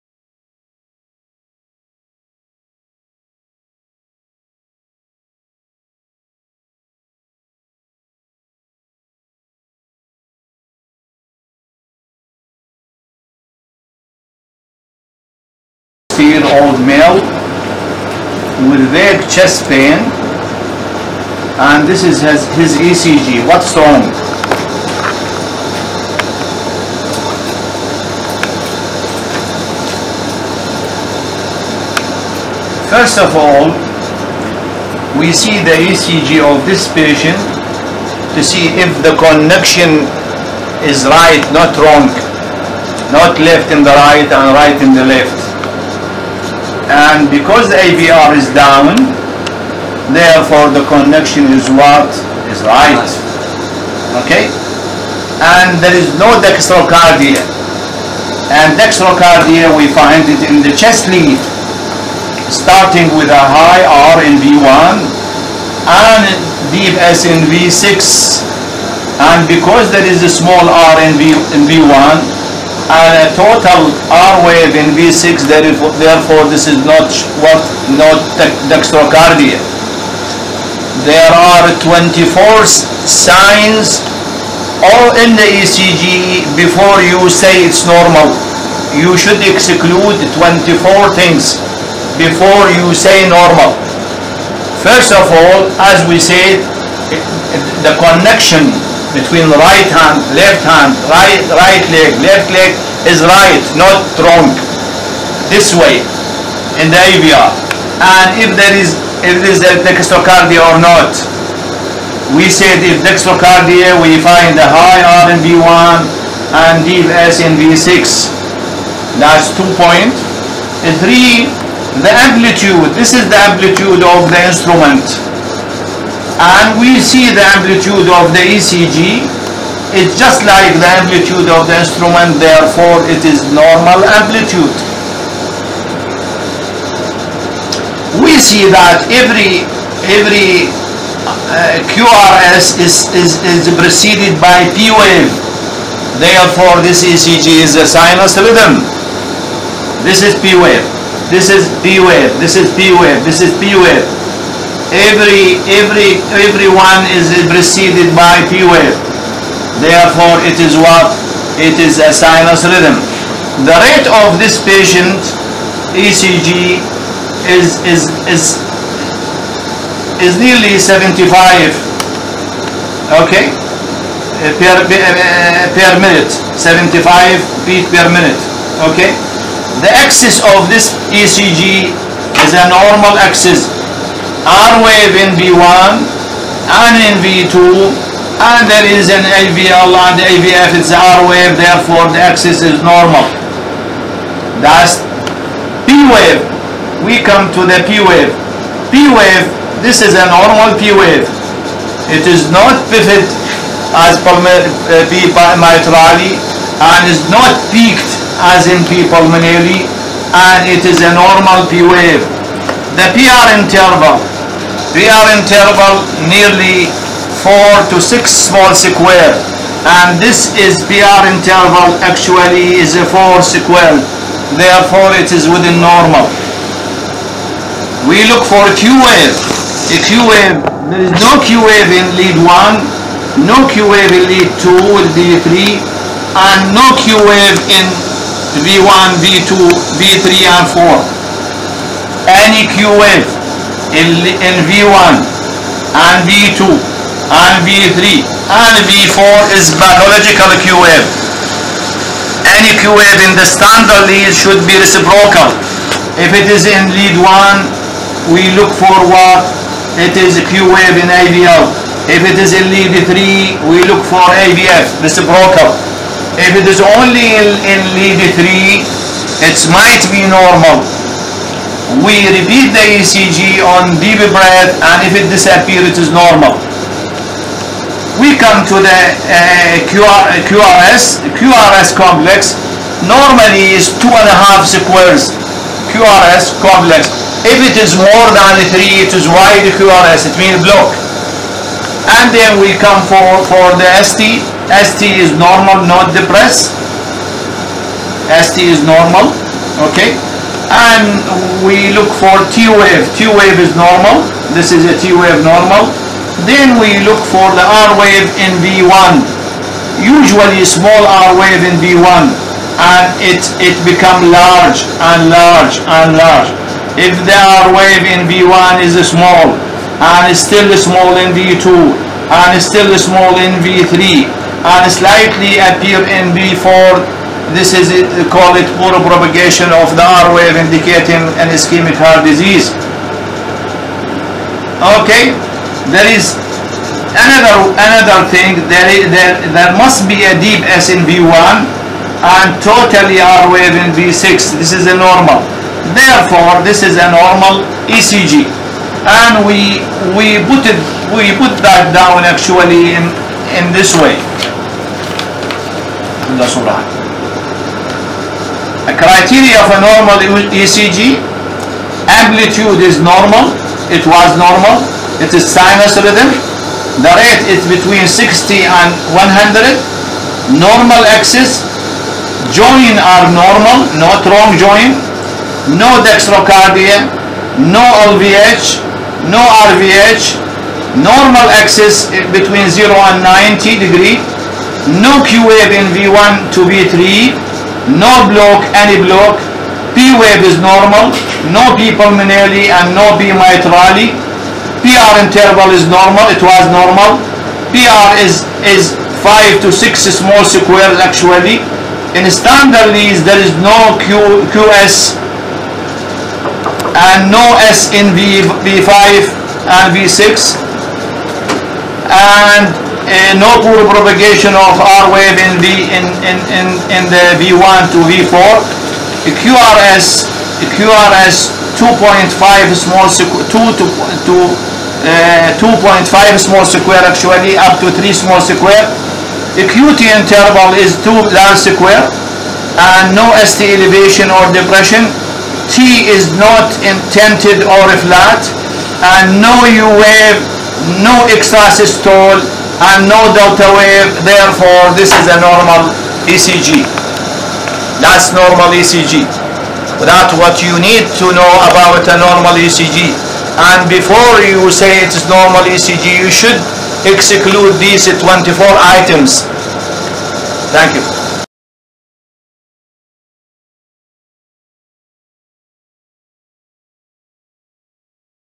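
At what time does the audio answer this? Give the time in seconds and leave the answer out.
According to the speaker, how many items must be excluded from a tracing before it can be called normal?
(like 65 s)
81 s.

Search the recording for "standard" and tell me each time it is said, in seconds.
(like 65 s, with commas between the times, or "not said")
253 s, 402 s.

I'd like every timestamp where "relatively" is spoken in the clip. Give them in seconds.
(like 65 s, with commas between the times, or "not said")
not said.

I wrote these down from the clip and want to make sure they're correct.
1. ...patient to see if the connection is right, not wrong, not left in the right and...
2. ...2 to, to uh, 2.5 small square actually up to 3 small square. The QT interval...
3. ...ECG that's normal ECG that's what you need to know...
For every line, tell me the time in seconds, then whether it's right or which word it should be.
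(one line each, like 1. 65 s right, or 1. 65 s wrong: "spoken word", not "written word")
1. 36 s right
2. 423 s right
3. 446 s right.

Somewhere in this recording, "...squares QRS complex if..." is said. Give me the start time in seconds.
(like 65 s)
284 s.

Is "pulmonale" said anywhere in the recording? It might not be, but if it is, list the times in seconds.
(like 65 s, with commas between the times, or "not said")
209 s, 391 s.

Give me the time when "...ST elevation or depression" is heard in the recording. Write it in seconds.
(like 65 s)
433 s.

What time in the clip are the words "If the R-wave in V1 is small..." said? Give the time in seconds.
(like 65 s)
316 s.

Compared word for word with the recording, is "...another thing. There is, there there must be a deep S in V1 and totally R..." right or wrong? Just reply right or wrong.
right.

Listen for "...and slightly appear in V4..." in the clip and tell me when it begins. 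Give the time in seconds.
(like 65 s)
324 s.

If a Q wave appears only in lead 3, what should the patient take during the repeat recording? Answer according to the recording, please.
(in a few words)
deep breath.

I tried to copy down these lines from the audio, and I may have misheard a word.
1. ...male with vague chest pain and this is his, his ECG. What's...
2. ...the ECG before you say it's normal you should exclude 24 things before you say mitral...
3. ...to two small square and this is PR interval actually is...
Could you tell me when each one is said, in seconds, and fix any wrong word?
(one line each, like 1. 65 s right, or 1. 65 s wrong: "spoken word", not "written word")
1. 16 s right
2. 85 s wrong: "normal", not "mitral"
3. 217 s wrong: "six", not "two".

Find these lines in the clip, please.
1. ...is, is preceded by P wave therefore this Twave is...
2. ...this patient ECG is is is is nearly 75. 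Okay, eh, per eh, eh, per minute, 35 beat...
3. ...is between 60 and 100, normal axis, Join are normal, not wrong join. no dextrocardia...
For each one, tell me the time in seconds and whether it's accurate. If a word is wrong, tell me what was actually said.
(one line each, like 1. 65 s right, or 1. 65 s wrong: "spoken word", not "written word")
1. 143 s wrong: "ECG", not "Twave"
2. 164 s wrong: "75", not "35"
3. 367 s right.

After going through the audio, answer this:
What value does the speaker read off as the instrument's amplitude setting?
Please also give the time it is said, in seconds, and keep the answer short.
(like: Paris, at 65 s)
2.3, at 119 s.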